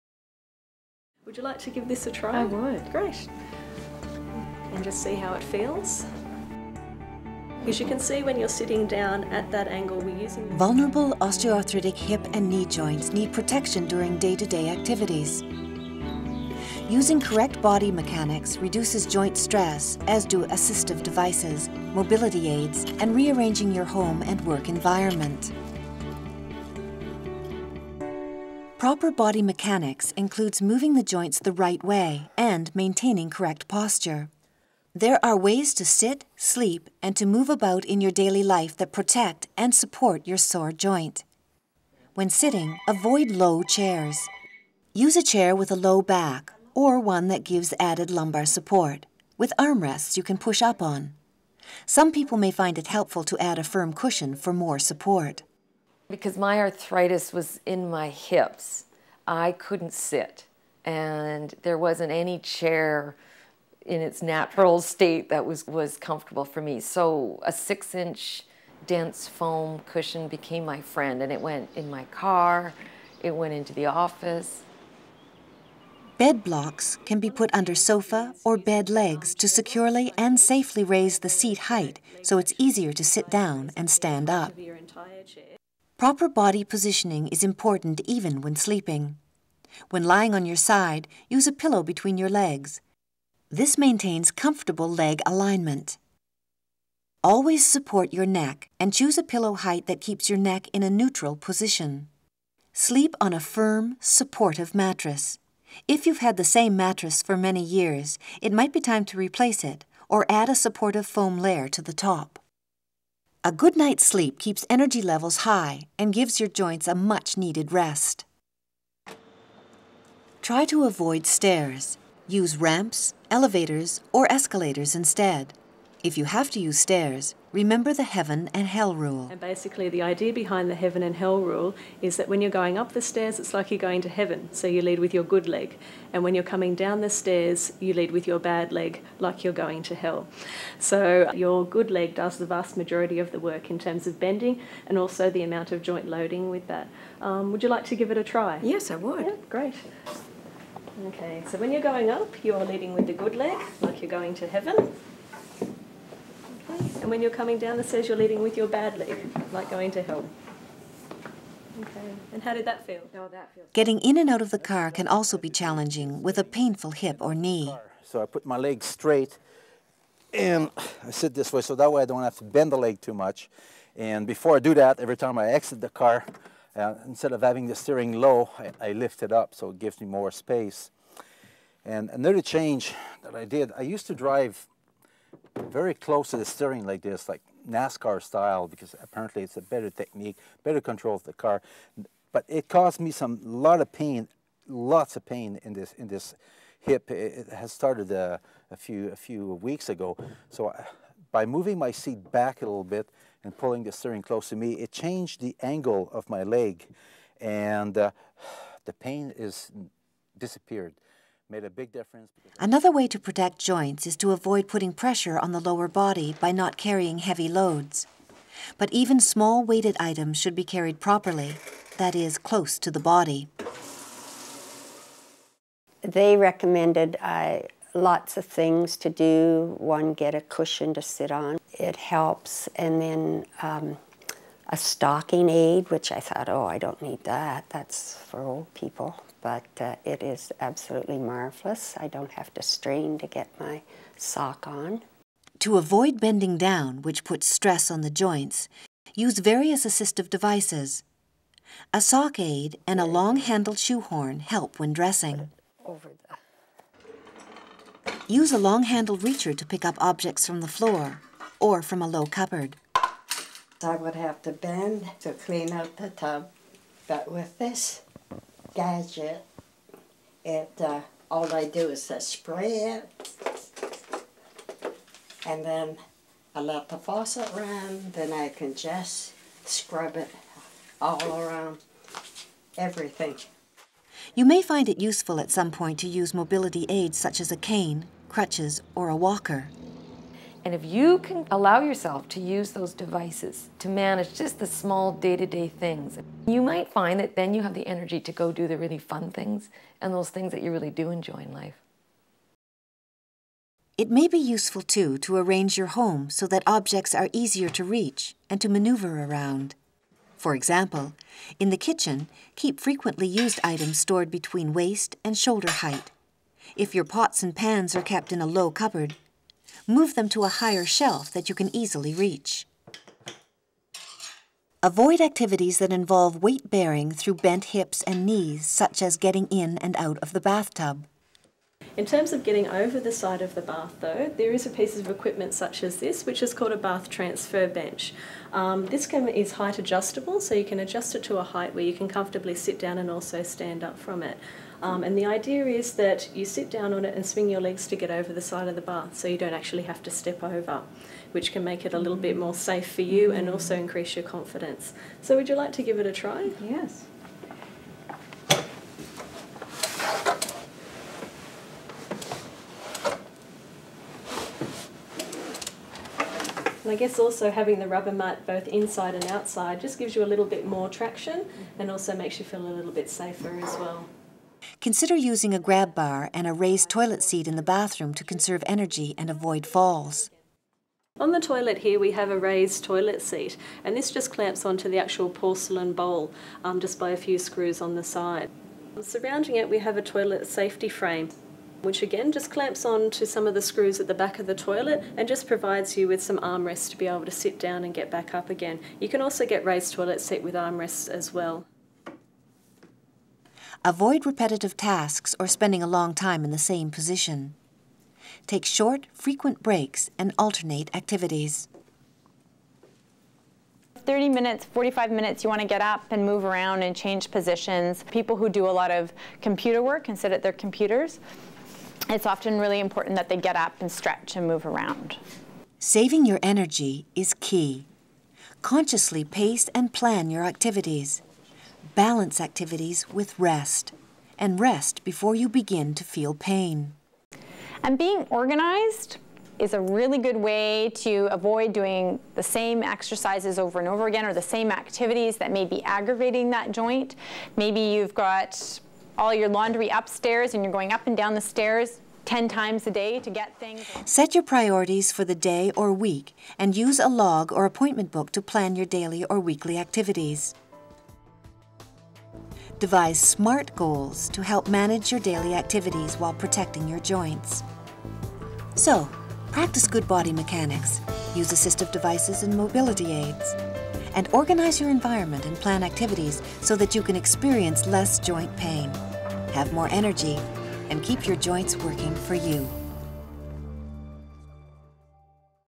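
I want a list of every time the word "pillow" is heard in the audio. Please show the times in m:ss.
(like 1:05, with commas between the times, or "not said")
1:31, 1:39.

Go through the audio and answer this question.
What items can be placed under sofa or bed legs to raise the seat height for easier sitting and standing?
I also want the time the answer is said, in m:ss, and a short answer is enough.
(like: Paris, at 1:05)
Bed blocks, at 1:16.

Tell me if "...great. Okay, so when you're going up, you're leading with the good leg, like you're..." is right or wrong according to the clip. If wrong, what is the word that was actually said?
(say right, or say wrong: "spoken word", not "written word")
right.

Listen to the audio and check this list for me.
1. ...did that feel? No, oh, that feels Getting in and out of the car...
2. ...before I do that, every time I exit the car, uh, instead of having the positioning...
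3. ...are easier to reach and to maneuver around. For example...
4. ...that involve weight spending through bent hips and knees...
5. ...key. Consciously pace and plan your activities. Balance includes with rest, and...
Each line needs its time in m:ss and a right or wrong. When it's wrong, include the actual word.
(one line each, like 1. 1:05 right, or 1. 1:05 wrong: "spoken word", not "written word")
1. 2:42 right
2. 2:54 wrong: "steering", not "positioning"
3. 5:07 right
4. 5:25 wrong: "bearing", not "spending"
5. 7:07 wrong: "activities", not "includes".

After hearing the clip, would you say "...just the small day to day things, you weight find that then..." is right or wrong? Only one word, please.
wrong.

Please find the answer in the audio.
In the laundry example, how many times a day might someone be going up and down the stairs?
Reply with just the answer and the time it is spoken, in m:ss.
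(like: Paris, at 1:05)
10, at 7:32.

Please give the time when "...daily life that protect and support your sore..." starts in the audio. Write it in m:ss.
0:38.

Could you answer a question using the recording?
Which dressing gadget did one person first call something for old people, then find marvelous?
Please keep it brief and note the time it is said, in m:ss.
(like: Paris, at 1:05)
stocking aid, at 3:54.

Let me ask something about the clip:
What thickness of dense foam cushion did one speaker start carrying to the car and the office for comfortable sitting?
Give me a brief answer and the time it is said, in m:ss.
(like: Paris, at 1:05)
6 inch, at 1:07.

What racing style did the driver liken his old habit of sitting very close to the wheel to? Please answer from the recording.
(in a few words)
NASCAR style.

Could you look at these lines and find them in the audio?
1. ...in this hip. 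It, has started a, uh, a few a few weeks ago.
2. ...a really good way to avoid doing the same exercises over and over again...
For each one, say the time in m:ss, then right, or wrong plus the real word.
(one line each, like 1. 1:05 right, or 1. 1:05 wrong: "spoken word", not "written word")
1. 3:15 right
2. 7:19 right.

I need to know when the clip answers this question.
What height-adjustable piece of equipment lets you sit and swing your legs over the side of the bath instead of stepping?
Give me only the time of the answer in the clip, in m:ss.
5:36.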